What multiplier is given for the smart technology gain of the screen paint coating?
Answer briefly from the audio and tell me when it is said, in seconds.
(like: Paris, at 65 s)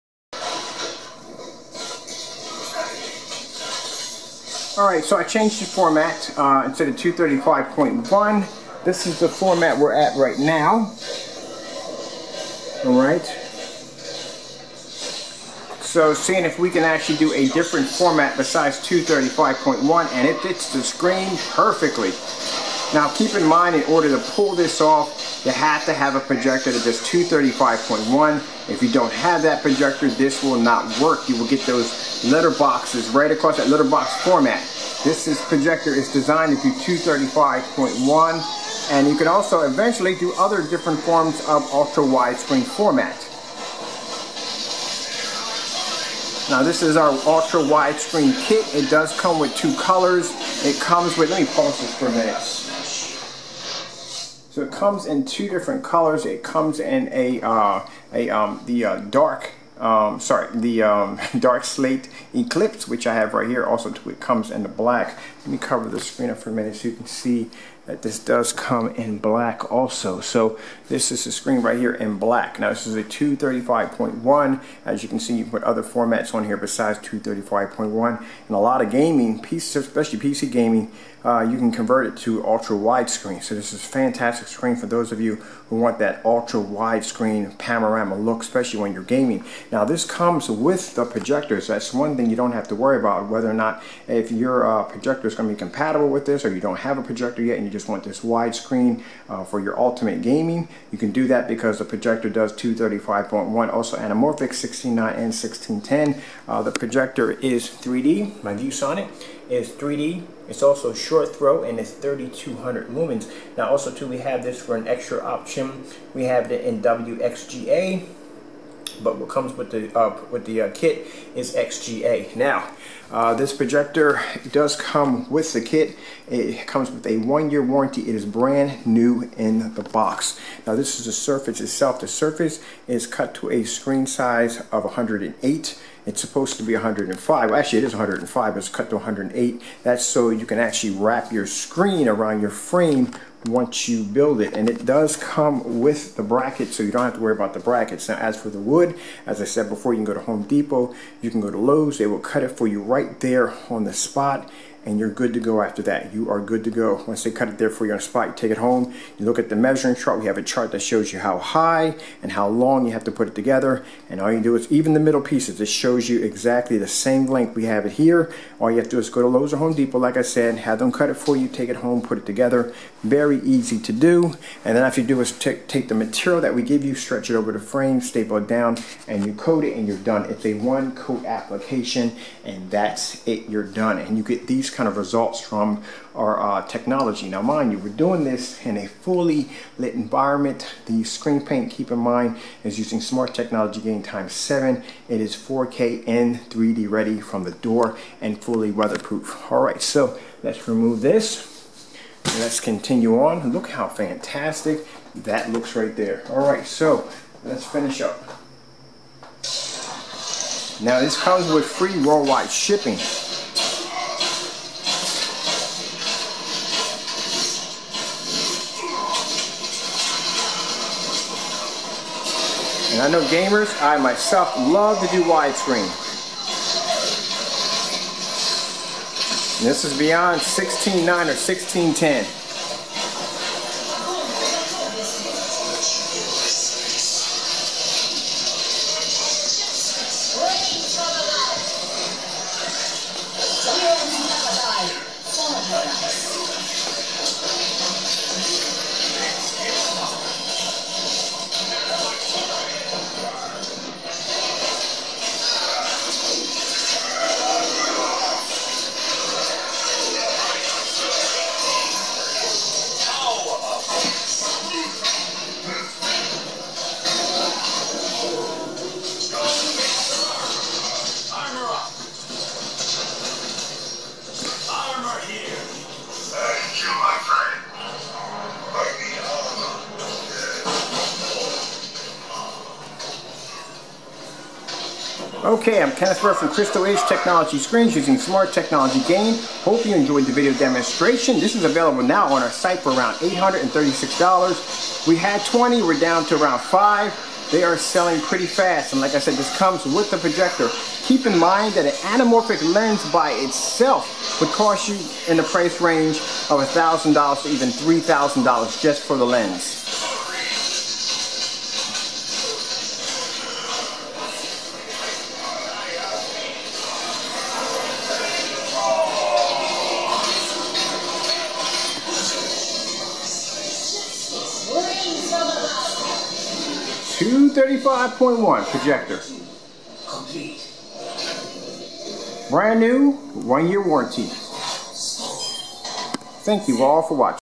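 Times seven, at 193 s.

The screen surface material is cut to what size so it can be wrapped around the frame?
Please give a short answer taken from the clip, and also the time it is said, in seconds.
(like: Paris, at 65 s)
108, at 138 s.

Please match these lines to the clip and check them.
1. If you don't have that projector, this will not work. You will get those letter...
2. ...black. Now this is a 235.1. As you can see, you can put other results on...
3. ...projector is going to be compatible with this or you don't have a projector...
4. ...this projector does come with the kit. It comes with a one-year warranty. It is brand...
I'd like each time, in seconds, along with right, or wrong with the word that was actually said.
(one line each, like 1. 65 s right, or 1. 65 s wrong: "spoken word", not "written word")
1. 28 s right
2. 72 s wrong: "formats", not "results"
3. 94 s right
4. 123 s right.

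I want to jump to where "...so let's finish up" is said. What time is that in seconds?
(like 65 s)
206 s.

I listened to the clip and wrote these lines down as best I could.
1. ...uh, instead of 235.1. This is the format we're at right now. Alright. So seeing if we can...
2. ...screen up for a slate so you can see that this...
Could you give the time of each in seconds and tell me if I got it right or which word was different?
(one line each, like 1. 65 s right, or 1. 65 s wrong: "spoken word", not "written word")
1. 6 s right
2. 66 s wrong: "minute", not "slate".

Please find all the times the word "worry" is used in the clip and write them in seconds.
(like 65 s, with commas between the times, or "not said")
92 s, 147 s.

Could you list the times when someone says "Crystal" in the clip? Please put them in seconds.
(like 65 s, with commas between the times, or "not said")
286 s.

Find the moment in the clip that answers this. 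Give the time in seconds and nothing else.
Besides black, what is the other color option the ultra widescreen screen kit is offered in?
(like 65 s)
61 s.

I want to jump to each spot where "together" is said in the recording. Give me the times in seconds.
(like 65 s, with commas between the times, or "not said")
163 s, 172 s.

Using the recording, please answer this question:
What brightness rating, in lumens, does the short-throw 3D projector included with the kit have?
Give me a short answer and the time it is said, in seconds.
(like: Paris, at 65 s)
3200, at 111 s.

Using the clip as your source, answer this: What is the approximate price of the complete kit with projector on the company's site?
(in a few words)
$836.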